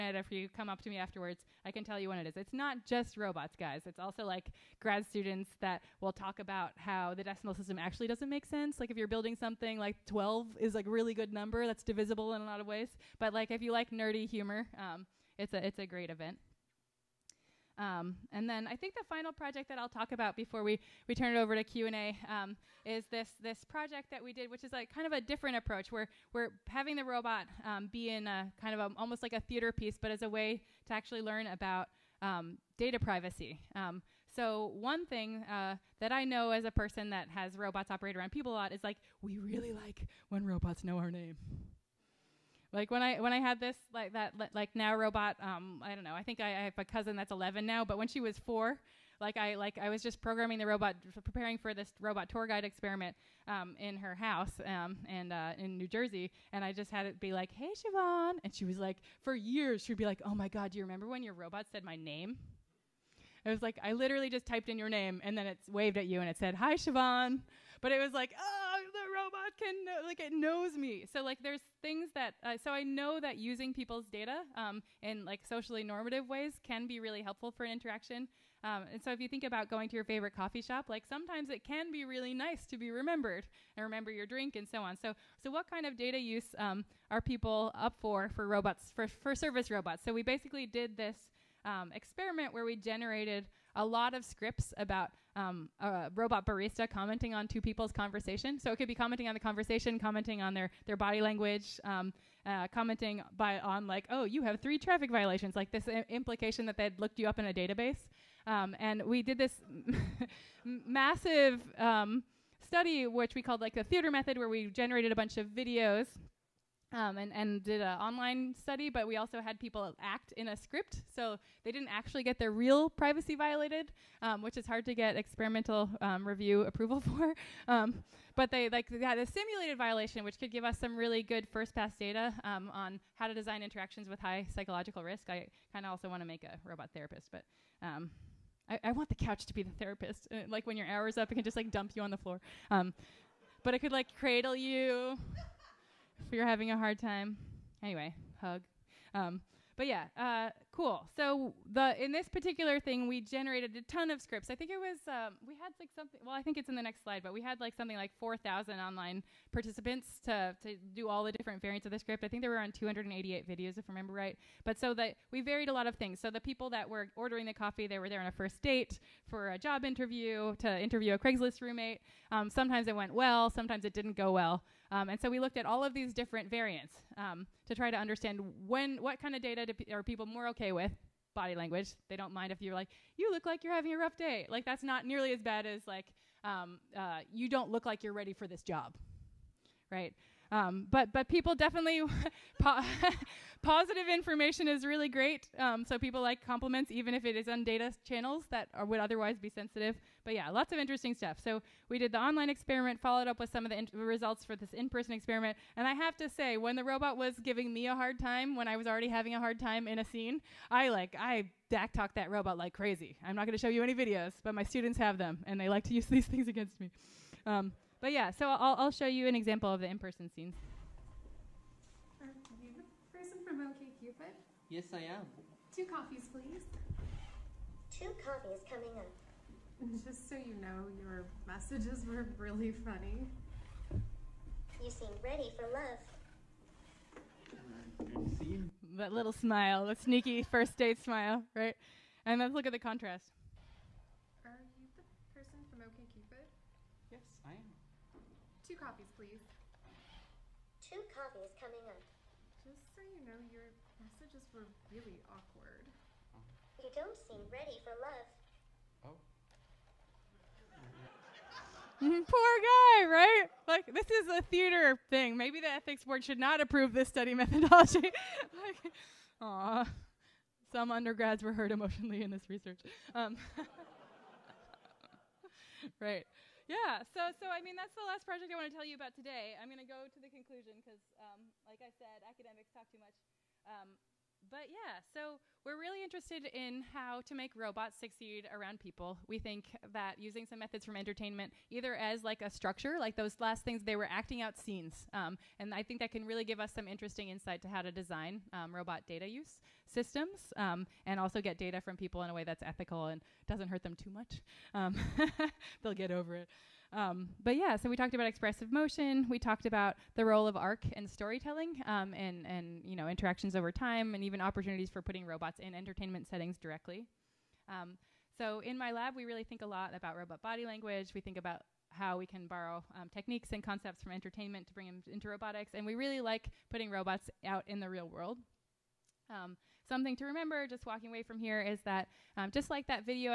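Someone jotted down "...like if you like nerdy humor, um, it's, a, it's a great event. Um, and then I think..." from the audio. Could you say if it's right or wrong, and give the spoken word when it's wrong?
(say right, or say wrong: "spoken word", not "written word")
right.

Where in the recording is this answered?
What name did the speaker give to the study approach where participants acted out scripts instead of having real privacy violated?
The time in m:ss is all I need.
1:53.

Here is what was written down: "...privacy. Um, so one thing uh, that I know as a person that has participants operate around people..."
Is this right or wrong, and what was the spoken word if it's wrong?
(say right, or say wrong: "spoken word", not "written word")
wrong: "robots", not "participants".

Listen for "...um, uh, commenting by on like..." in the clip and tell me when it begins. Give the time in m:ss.
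1:41.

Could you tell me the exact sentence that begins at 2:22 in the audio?
but it could like cradle you if you're having a hard time.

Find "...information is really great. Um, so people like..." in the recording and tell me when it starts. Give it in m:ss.
3:14.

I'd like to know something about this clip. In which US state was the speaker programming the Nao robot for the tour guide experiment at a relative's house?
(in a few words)
New Jersey.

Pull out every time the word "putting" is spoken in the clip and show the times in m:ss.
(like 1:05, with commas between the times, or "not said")
5:15, 5:26.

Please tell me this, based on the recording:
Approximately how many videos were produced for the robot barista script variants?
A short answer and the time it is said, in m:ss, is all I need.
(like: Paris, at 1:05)
288, at 2:42.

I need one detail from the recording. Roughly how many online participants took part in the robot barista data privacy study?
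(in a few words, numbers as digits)
4000.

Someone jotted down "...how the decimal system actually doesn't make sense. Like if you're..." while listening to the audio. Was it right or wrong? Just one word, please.
right.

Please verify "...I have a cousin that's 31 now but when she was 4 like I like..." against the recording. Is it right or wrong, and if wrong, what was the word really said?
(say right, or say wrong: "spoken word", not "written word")
wrong: "11", not "31".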